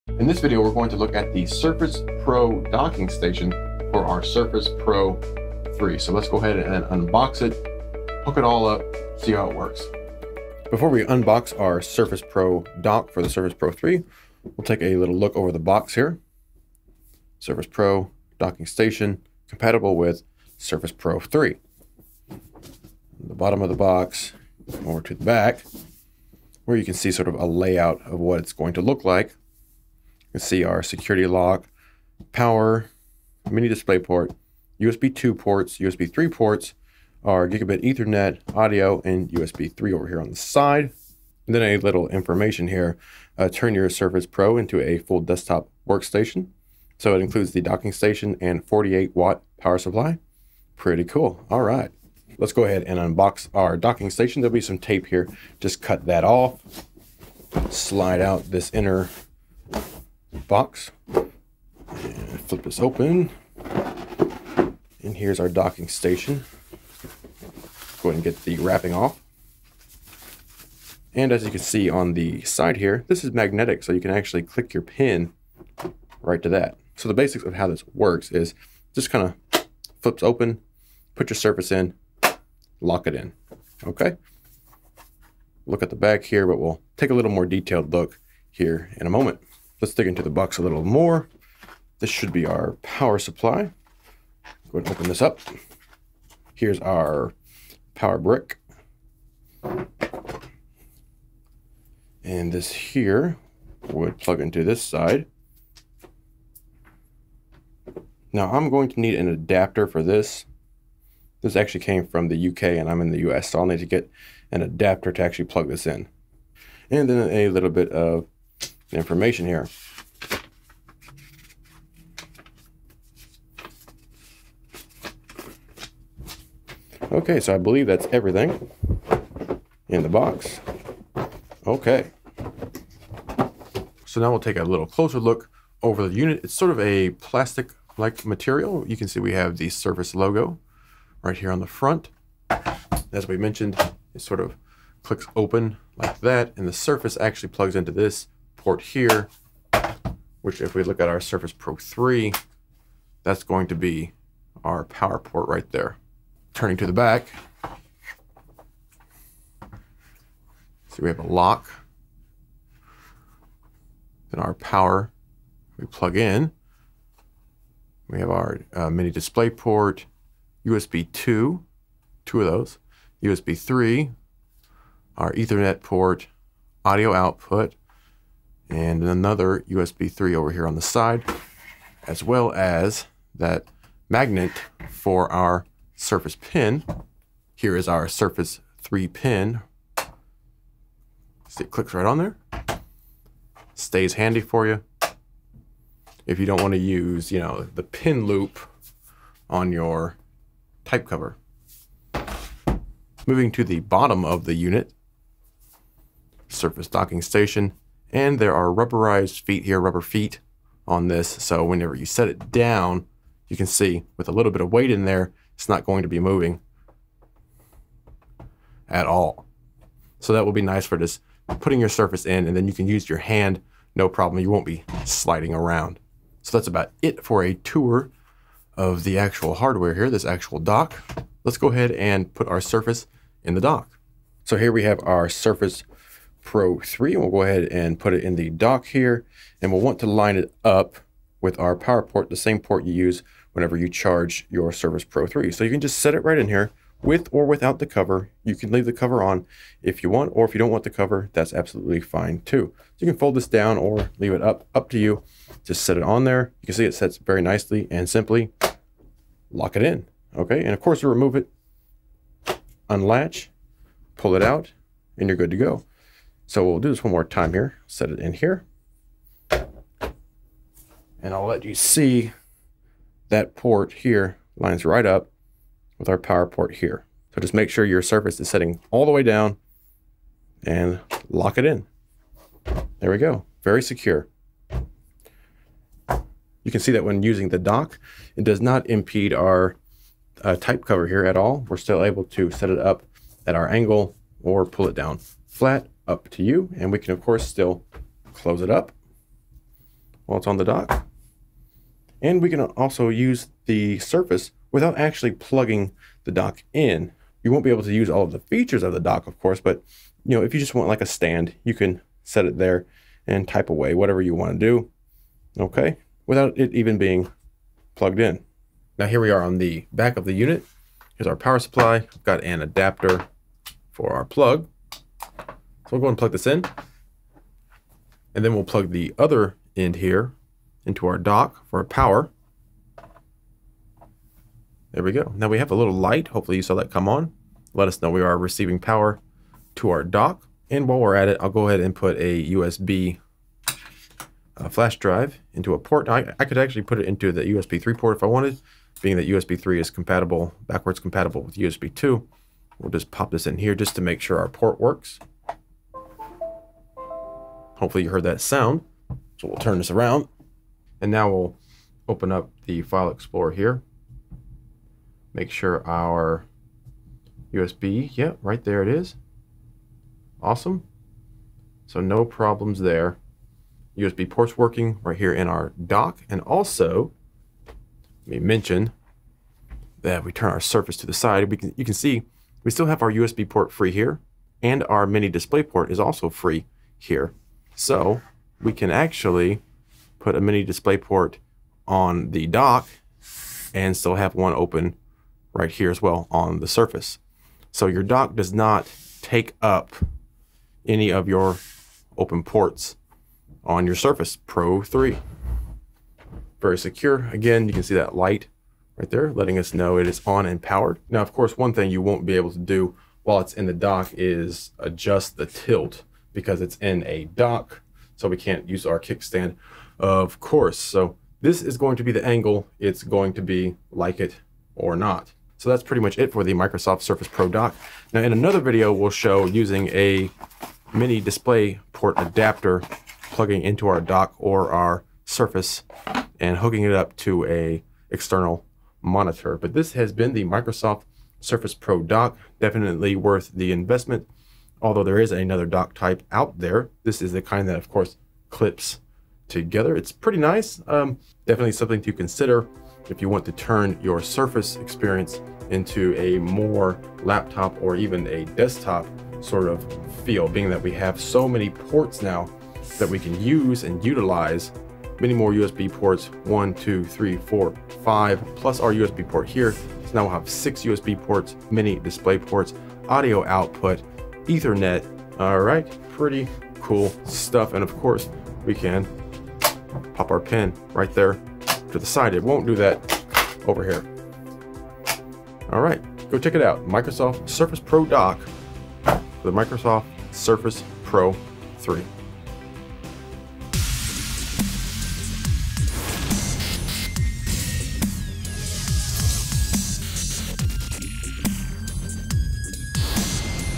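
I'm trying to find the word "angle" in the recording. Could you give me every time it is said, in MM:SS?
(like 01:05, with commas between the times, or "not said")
04:53, 07:02.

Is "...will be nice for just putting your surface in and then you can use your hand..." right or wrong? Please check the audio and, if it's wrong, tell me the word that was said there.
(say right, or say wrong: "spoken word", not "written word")
right.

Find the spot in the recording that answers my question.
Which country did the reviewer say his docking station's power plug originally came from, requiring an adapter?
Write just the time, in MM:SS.
01:52.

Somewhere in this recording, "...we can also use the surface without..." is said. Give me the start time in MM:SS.
05:02.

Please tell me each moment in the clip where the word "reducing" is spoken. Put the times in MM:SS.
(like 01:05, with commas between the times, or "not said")
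not said.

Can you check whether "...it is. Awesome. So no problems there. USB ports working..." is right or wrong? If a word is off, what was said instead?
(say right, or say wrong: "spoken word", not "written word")
right.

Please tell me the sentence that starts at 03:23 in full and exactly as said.
Moving to the bottom of the unit, Surface docking station, and there are rubberized feet here, rubber feet on this.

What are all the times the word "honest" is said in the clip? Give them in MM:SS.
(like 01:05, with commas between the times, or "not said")
not said.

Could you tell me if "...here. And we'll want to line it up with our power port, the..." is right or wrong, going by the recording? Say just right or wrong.
right.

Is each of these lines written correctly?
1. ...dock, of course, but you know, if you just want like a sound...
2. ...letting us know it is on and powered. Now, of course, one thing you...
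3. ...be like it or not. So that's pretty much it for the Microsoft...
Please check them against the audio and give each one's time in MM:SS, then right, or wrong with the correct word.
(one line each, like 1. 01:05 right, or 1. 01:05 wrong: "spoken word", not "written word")
1. 05:08 wrong: "stand", not "sound"
2. 06:49 right
3. 07:03 right.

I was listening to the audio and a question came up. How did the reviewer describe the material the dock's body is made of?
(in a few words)
plastic-like material.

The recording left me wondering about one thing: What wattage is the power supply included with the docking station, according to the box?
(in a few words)
48 watt.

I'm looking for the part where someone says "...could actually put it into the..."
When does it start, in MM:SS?
05:46.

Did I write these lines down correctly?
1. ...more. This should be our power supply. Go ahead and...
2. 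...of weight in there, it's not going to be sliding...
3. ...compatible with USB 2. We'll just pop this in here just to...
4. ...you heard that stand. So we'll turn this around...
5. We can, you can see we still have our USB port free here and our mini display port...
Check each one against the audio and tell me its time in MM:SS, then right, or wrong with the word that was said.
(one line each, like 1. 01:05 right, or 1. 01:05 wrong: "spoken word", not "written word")
1. 01:30 right
2. 03:34 wrong: "moving", not "sliding"
3. 05:51 right
4. 05:58 wrong: "sound", not "stand"
5. 06:21 right.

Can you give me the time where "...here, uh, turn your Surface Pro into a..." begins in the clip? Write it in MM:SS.
00:42.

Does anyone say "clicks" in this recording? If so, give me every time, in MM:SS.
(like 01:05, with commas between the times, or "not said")
01:14, 02:25, 03:11.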